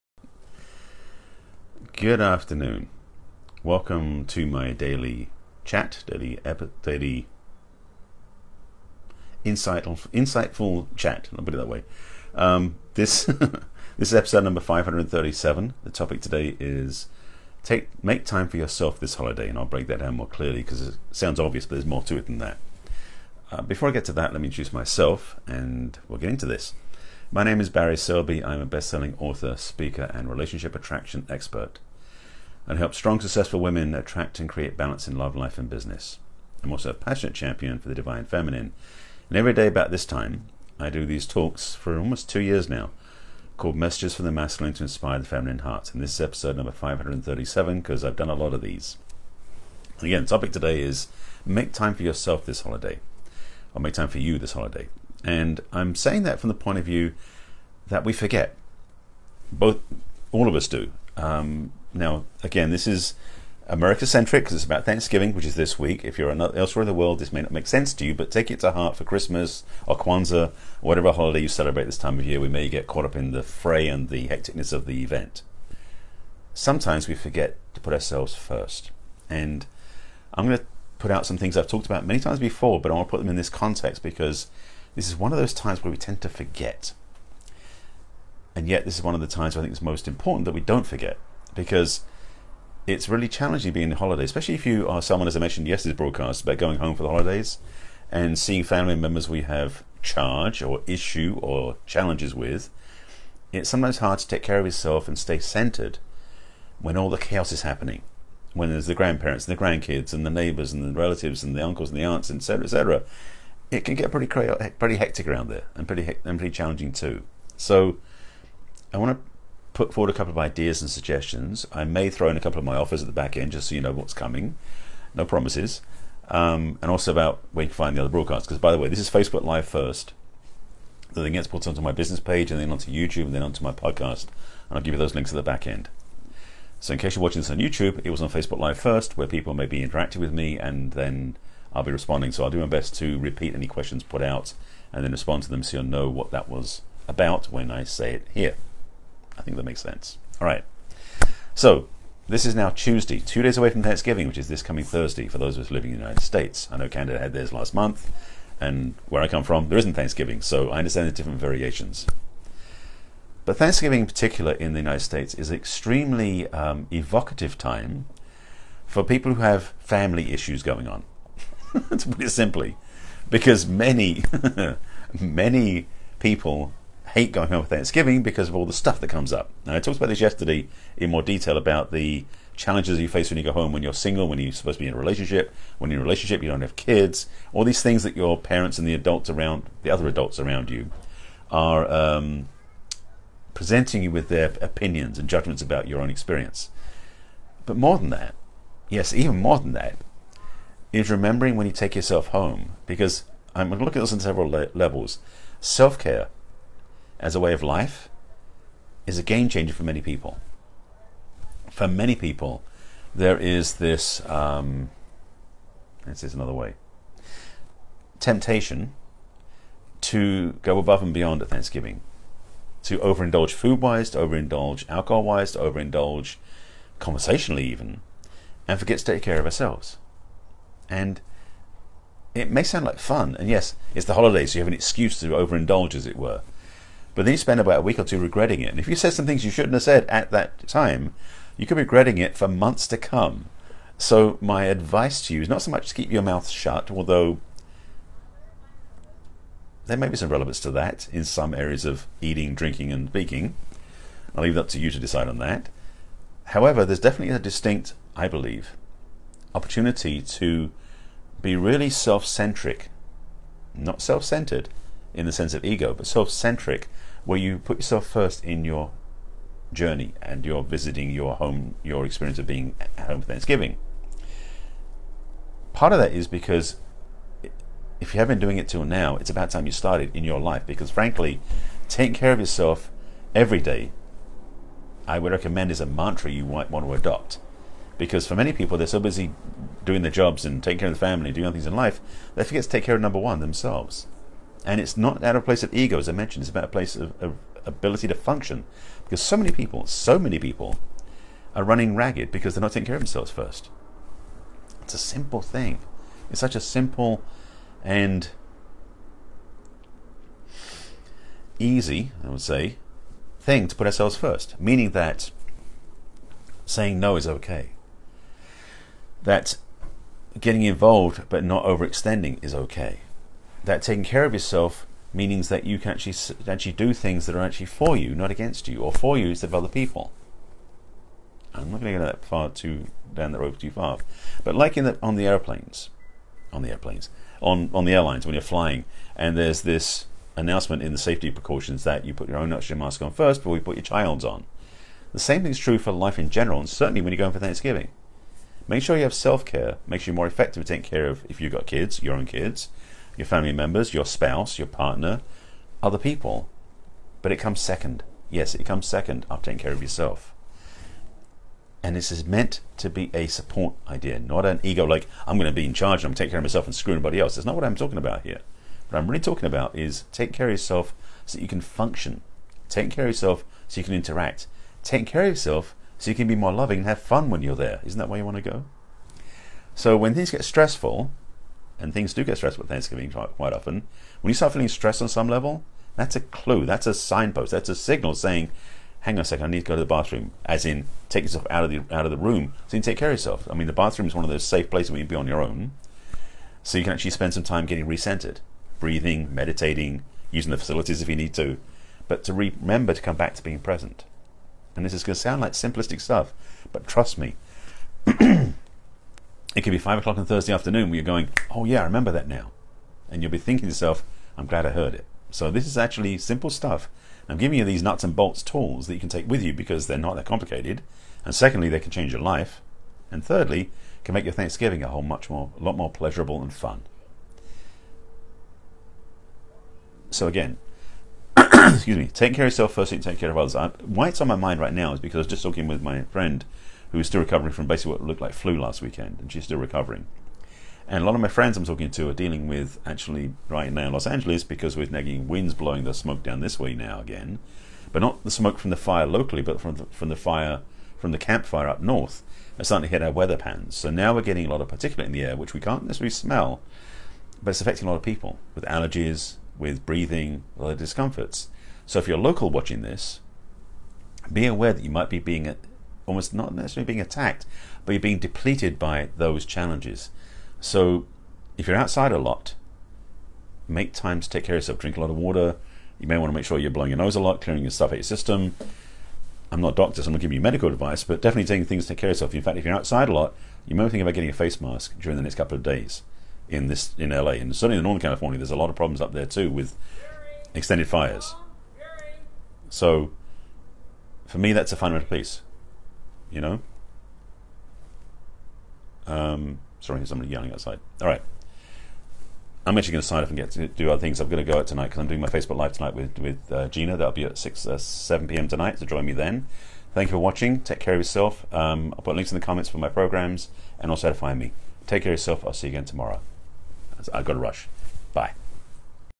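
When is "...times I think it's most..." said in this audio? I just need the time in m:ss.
1:29.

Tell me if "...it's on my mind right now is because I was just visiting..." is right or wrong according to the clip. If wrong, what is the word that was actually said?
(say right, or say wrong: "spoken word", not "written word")
wrong: "talking", not "visiting".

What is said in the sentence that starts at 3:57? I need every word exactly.
But then you spend about a week or two regretting it.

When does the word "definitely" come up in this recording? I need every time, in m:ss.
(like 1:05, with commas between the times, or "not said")
4:16, 8:01.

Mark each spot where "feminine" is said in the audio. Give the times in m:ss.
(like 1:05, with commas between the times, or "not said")
0:38, 0:45.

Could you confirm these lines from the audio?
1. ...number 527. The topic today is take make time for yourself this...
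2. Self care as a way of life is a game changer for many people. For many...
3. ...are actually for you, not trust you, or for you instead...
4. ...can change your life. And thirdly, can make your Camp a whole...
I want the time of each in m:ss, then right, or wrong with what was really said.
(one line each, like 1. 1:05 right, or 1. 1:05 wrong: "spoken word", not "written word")
1. 0:14 wrong: "537", not "527"
2. 3:25 right
3. 5:27 wrong: "against", not "trust"
4. 7:01 wrong: "Thanksgiving", not "Camp".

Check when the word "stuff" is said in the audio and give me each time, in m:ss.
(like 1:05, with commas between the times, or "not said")
2:58, 6:45, 6:56, 7:57.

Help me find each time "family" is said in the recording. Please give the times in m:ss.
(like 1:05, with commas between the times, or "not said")
1:38, 2:49, 4:50, 5:53.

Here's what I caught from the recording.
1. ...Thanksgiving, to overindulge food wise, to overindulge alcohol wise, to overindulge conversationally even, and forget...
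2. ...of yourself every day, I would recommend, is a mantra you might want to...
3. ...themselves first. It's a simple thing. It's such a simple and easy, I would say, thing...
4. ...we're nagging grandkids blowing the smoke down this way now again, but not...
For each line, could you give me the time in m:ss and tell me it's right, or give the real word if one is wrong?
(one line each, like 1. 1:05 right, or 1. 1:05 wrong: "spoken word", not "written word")
1. 3:41 right
2. 4:42 right
3. 5:03 right
4. 7:24 wrong: "winds", not "grandkids".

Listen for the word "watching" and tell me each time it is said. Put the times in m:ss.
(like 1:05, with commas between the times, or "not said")
2:17, 7:42, 8:30.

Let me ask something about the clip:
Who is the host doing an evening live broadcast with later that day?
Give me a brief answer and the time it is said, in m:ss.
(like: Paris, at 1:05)
Gina, at 8:26.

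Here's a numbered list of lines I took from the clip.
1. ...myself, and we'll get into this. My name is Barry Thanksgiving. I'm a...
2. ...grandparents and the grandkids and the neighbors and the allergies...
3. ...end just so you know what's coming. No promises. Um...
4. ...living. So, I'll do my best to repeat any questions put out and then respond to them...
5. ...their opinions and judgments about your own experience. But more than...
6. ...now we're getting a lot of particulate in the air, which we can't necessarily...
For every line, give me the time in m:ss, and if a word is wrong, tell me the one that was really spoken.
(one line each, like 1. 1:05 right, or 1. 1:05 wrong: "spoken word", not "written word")
1. 0:24 wrong: "Selby", not "Thanksgiving"
2. 1:48 wrong: "relatives", not "allergies"
3. 2:03 right
4. 2:21 wrong: "responding", not "living"
5. 3:14 right
6. 7:33 right.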